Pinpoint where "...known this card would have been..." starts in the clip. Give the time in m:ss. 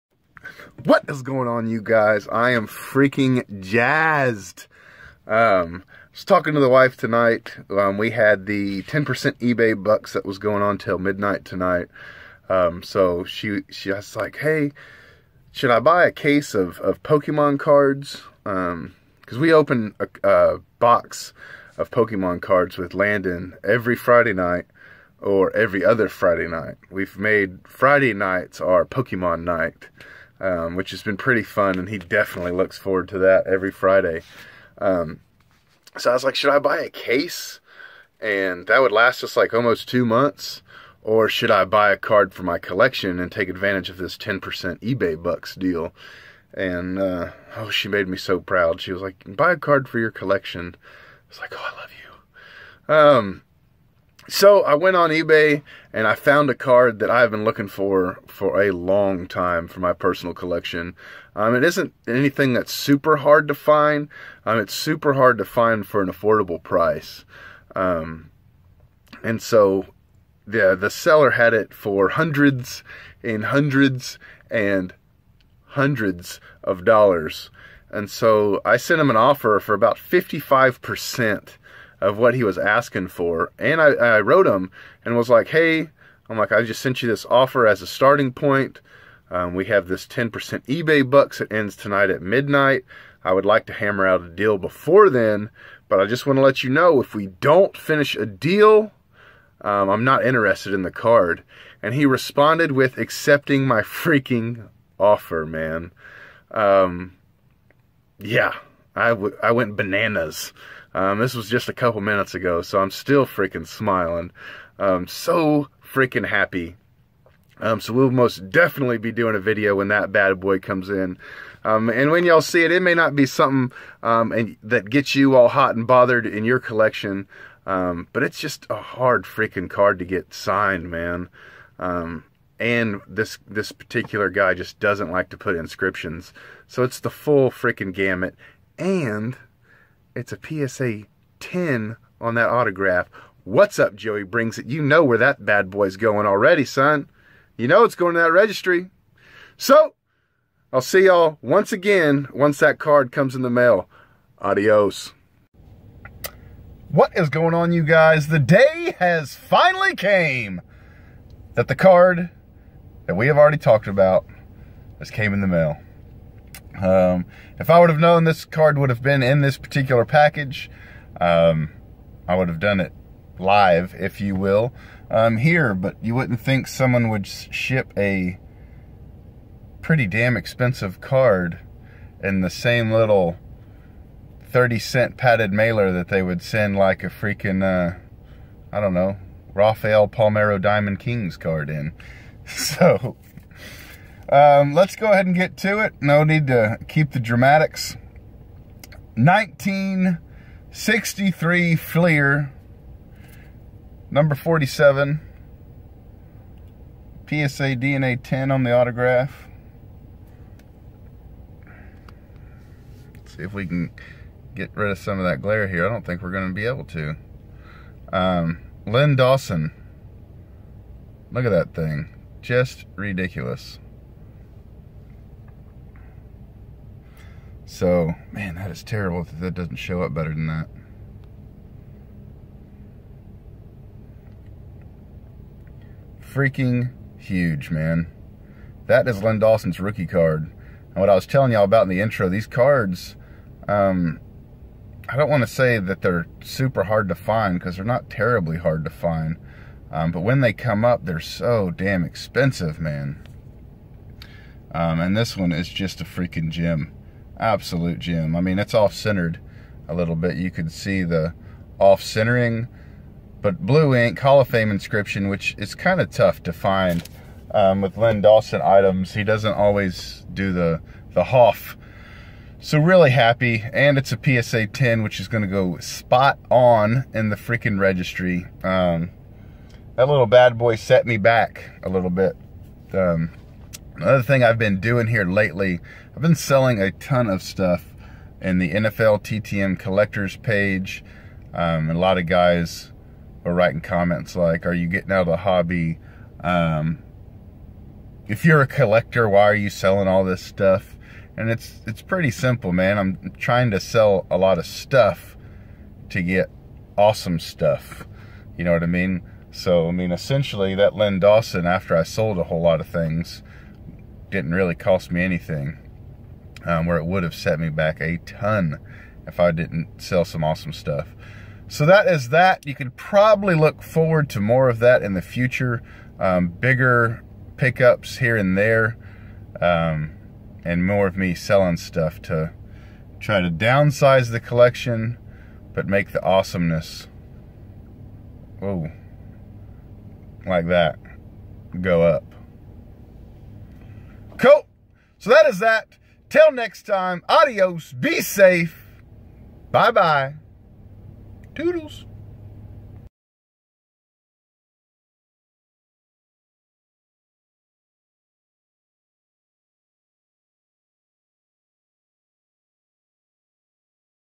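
2:47.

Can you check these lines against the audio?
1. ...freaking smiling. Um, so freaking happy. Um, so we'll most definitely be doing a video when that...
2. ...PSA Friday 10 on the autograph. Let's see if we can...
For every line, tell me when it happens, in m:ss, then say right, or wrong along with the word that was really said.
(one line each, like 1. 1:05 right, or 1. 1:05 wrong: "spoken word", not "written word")
1. 1:53 right
2. 3:27 wrong: "DNA", not "Friday".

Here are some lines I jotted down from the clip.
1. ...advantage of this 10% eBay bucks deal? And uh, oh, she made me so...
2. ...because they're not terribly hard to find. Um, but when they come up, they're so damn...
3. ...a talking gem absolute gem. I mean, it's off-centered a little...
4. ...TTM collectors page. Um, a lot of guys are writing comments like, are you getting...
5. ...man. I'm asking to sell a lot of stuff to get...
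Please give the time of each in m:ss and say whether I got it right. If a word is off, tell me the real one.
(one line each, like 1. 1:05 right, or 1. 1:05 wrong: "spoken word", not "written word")
1. 0:43 right
2. 4:07 right
3. 4:16 wrong: "freaking", not "talking"
4. 4:49 right
5. 5:02 wrong: "trying", not "asking".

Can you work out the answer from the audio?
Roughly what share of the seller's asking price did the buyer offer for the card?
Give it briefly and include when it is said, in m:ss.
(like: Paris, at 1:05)
55%, at 1:19.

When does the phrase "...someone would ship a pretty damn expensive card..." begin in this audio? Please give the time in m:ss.
2:56.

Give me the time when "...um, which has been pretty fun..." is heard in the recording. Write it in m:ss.
0:30.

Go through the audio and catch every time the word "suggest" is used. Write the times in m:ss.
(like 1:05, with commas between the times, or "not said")
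not said.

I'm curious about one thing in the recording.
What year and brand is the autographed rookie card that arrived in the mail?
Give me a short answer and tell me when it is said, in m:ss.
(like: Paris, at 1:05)
1963 Fleer, at 3:19.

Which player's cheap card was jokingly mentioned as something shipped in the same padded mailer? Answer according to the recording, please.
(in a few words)
Rafael Palmeiro.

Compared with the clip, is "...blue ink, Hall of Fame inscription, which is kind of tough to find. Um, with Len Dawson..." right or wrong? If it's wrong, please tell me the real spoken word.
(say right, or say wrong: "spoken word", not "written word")
right.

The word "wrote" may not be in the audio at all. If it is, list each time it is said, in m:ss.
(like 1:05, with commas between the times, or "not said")
1:24.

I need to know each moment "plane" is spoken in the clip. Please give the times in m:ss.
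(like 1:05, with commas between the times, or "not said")
not said.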